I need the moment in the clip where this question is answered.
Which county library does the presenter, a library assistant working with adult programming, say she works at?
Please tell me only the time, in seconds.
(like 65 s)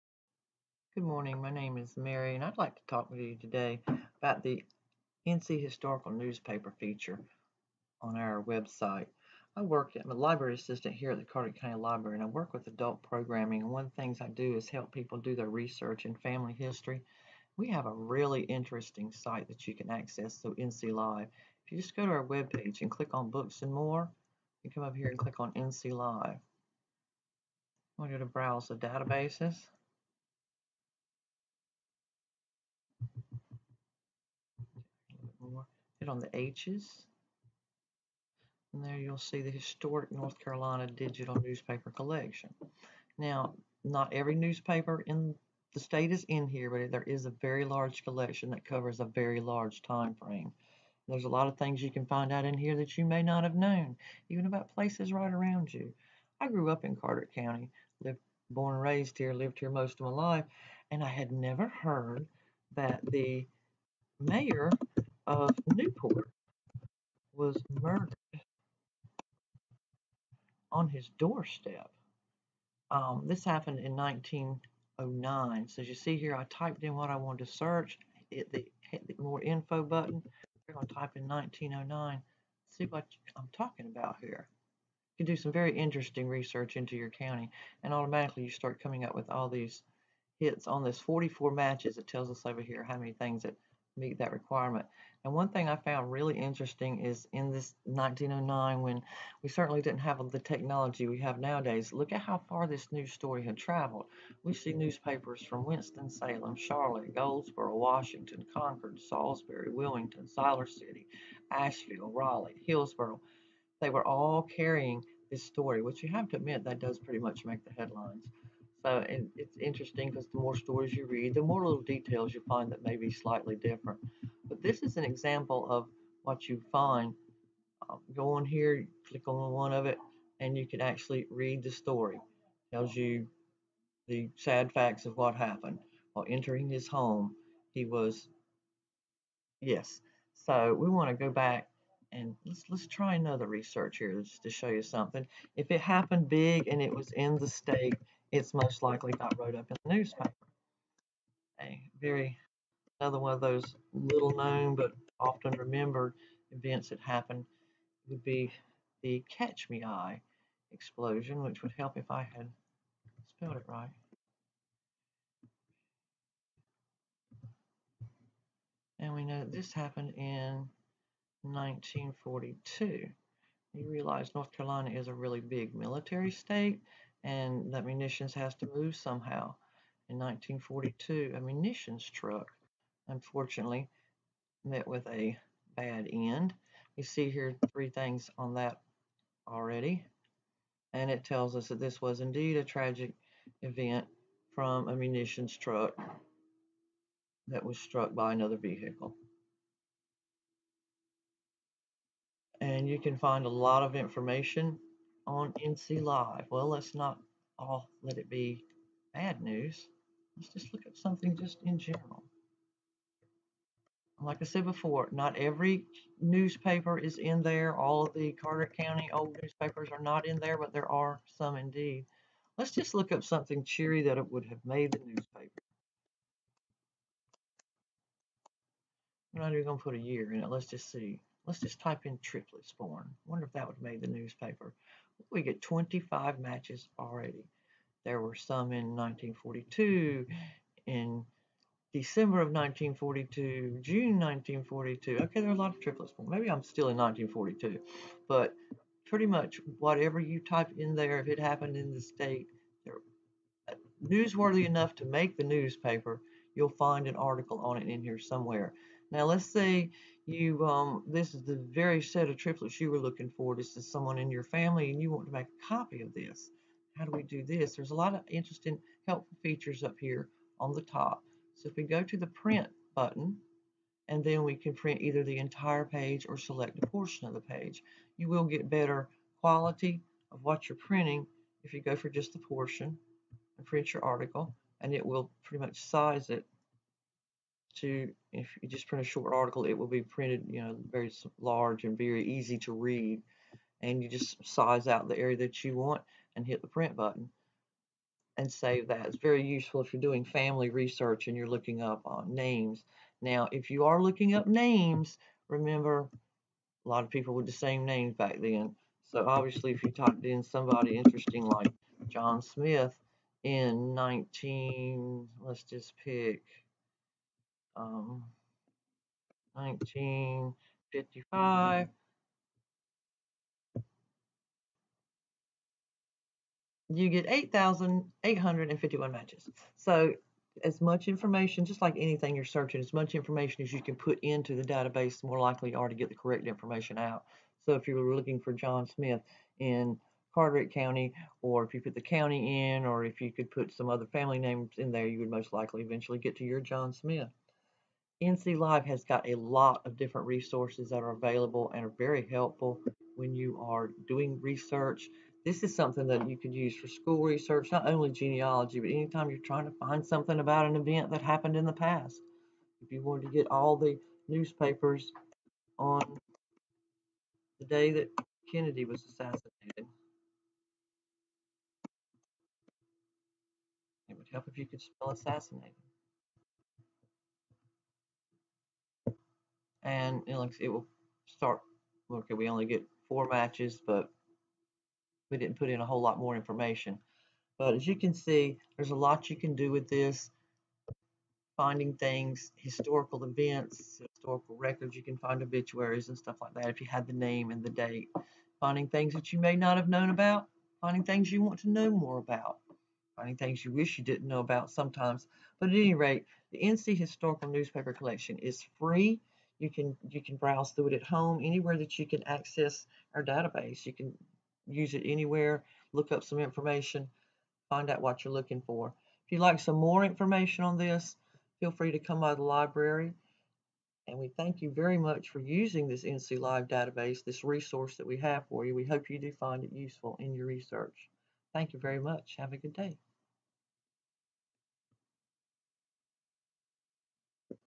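11 s.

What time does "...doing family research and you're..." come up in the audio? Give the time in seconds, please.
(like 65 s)
300 s.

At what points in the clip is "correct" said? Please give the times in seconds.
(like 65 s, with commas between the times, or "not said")
336 s.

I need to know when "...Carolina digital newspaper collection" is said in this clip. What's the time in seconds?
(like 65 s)
40 s.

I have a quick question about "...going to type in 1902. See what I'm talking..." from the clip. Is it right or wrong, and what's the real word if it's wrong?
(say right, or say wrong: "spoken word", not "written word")
wrong: "1909", not "1902".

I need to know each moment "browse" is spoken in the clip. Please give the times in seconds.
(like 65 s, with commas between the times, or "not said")
28 s, 410 s.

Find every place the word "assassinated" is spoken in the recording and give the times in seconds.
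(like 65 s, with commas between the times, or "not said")
369 s, 375 s.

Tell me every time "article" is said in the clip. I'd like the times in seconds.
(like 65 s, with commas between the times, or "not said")
257 s, 284 s, 289 s.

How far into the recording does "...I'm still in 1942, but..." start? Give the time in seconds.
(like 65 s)
246 s.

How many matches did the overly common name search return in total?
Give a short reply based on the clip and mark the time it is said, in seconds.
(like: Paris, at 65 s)
8,851, at 327 s.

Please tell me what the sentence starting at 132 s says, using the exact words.
It tells you the sad facts of what happened.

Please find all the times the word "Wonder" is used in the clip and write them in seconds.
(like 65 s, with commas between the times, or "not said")
233 s.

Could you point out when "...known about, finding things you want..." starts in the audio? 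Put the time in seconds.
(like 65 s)
399 s.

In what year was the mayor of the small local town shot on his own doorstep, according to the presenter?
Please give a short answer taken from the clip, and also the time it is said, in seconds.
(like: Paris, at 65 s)
1909, at 73 s.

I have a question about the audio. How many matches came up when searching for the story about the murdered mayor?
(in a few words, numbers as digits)
44.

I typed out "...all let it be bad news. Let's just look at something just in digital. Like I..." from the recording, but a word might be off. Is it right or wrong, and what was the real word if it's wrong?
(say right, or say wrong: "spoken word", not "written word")
wrong: "general", not "digital".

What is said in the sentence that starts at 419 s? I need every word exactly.
If you'd like some more information on this, feel free to come by the library.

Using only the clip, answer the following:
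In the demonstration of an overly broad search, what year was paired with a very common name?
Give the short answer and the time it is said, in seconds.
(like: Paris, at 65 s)
1955, at 319 s.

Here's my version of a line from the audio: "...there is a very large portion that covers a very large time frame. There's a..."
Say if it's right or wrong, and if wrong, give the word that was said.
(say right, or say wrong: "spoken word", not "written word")
wrong: "collection", not "portion".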